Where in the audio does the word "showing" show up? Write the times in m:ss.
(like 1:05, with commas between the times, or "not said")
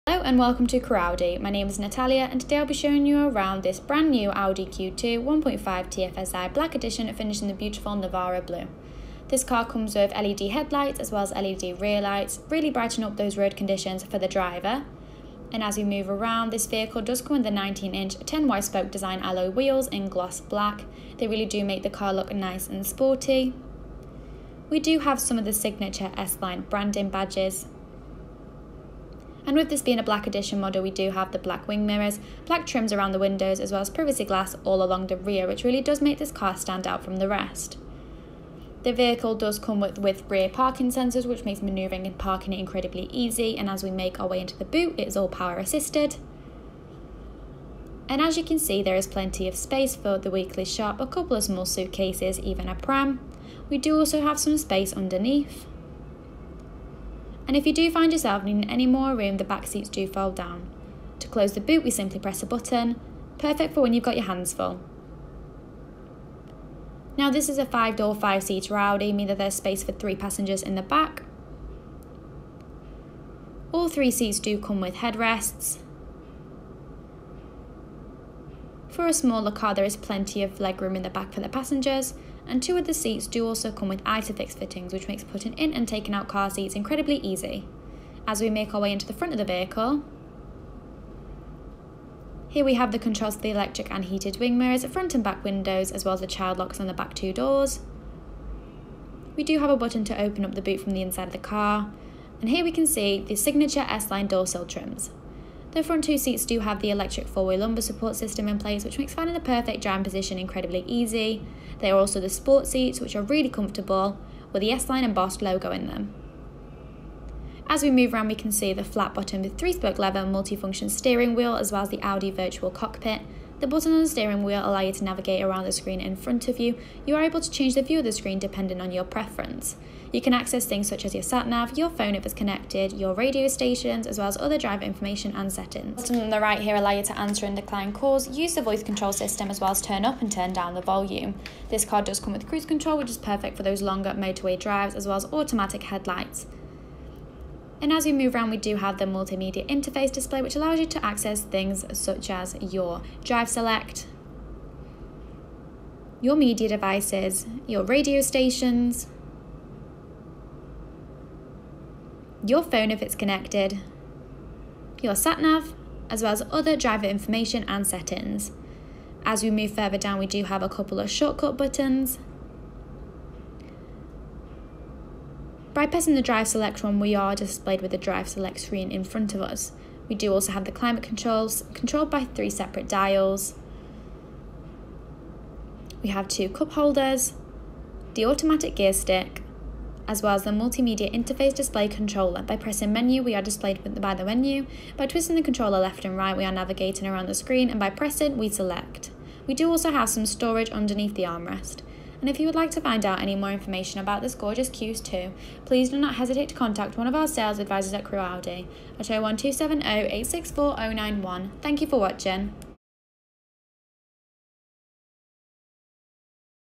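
0:02.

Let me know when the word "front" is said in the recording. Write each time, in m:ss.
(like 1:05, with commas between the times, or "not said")
1:29, 1:34, 1:45, 2:06, 2:59.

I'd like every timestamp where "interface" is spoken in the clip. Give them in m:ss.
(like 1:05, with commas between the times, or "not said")
2:29, 3:11.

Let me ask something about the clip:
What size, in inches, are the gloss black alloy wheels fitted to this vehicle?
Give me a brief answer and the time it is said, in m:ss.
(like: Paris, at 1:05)
19-inch, at 0:17.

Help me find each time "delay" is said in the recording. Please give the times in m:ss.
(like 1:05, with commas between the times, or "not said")
not said.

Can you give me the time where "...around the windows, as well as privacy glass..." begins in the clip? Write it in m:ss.
0:32.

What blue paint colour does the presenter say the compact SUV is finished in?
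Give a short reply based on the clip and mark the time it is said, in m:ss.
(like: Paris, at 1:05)
Navarra blue, at 0:07.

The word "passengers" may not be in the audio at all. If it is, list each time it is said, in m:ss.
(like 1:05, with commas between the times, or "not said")
1:10, 1:21.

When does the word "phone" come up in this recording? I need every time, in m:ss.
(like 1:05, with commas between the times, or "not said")
2:11, 2:42.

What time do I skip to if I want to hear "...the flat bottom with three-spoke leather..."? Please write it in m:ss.
1:58.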